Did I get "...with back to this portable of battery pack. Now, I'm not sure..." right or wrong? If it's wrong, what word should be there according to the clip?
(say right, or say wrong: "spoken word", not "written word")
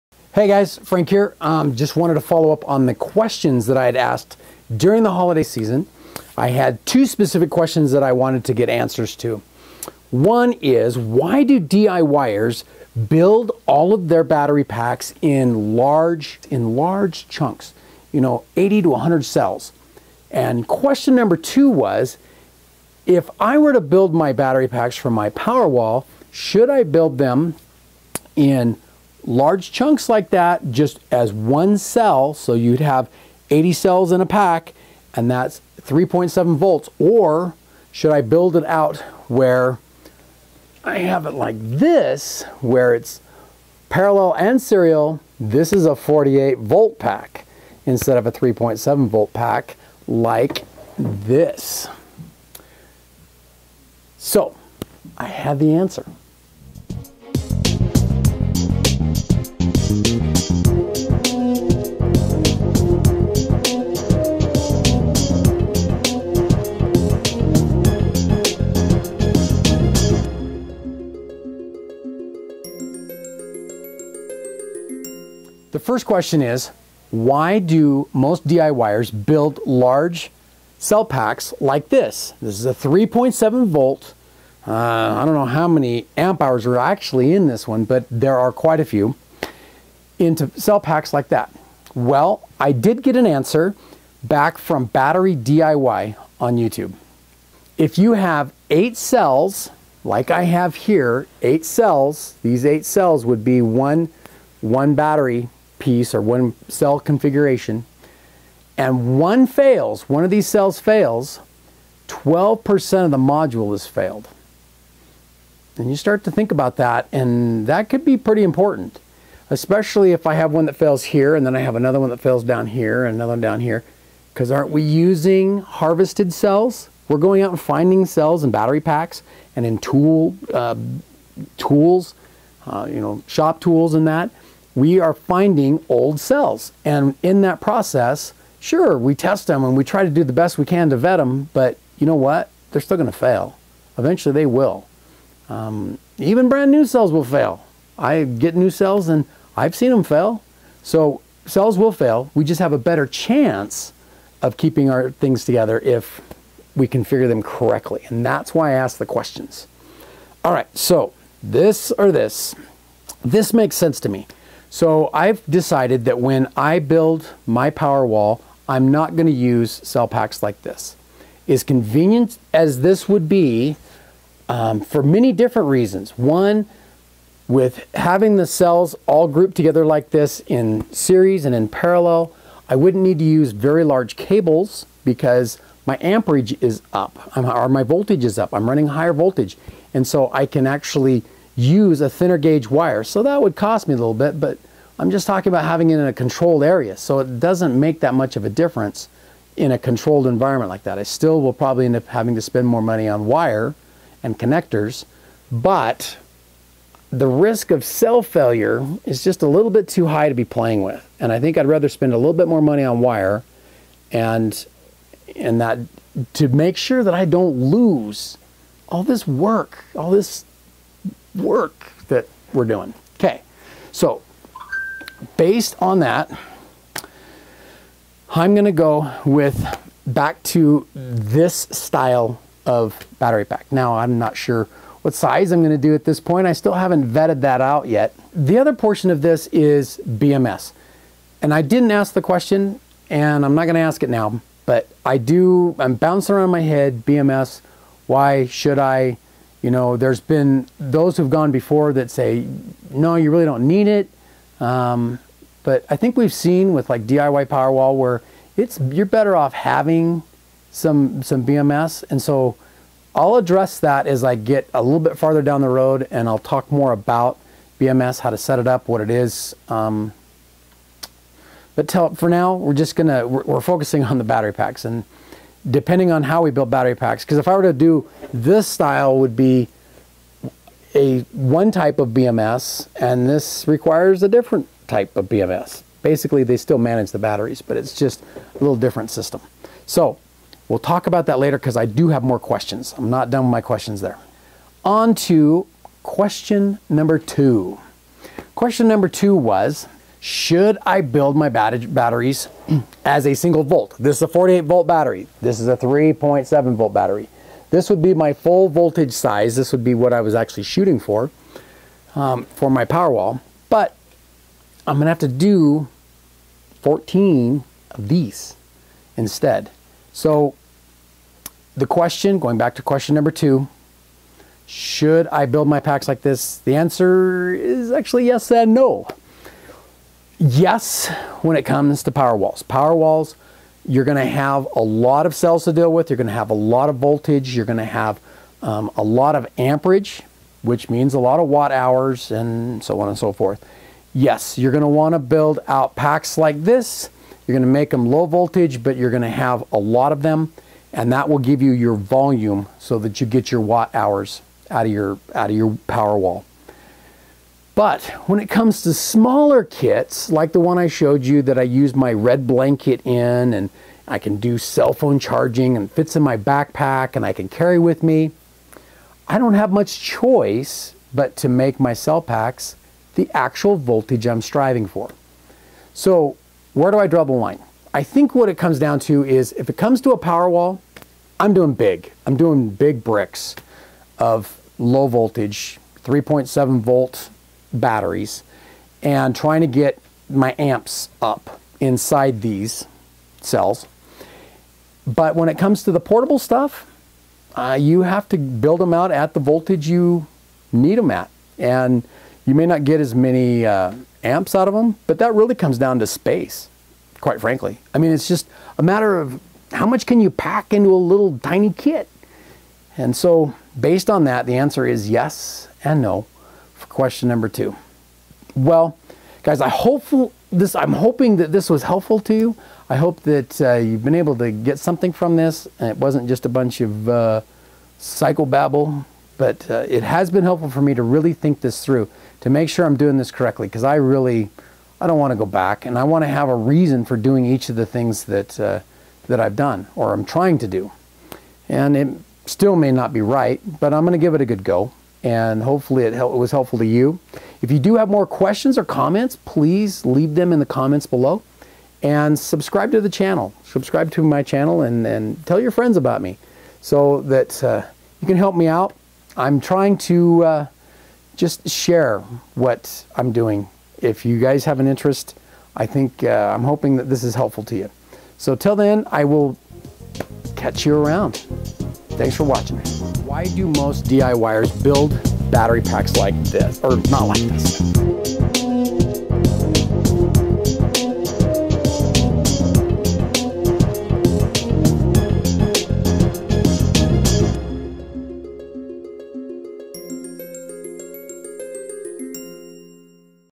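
wrong: "style", not "portable".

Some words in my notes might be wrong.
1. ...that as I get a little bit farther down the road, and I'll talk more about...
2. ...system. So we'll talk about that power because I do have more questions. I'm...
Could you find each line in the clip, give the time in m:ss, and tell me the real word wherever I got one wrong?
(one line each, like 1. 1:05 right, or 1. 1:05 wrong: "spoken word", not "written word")
1. 4:23 right
2. 4:49 wrong: "later", not "power".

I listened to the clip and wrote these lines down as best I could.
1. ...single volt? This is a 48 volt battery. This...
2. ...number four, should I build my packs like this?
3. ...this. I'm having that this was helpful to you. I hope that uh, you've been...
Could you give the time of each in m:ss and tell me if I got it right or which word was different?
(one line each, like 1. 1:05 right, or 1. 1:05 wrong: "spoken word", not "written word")
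1. 5:03 right
2. 5:23 wrong: "two", not "four"
3. 7:00 wrong: "hoping", not "having".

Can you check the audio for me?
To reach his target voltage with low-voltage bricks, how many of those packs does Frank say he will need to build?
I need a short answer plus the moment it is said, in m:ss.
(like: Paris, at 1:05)
14, at 5:16.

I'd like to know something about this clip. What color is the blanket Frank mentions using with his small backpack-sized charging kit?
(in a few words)
Red.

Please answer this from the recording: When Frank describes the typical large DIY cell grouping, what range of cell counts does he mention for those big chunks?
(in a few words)
80 to 100.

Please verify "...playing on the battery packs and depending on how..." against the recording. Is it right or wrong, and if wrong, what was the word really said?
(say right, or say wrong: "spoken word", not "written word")
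wrong: "focusing", not "playing".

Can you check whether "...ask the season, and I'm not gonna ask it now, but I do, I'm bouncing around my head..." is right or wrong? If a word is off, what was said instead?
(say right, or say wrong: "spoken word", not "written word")
wrong: "question", not "season".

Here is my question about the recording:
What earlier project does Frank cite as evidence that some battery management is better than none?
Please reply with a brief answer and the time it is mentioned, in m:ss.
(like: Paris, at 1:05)
DIY Powerwall, at 4:17.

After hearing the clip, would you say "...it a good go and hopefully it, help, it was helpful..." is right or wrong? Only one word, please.
right.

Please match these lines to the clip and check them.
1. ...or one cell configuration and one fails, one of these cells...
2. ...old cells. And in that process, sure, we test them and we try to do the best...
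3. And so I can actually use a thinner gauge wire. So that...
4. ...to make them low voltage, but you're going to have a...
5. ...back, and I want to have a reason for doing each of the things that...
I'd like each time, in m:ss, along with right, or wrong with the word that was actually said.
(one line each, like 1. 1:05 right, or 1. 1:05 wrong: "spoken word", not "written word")
1. 1:46 right
2. 2:15 right
3. 3:09 right
4. 5:47 right
5. 7:15 right.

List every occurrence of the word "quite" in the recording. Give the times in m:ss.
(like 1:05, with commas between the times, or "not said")
1:28, 6:47.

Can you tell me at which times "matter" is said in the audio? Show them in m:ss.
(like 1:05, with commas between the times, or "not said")
6:48.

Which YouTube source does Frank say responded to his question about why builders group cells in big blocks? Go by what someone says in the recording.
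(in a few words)
Battery DIY.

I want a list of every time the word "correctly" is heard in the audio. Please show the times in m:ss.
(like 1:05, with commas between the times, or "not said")
2:37, 7:13.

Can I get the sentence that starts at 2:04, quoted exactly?
Because aren't we using harvested cells?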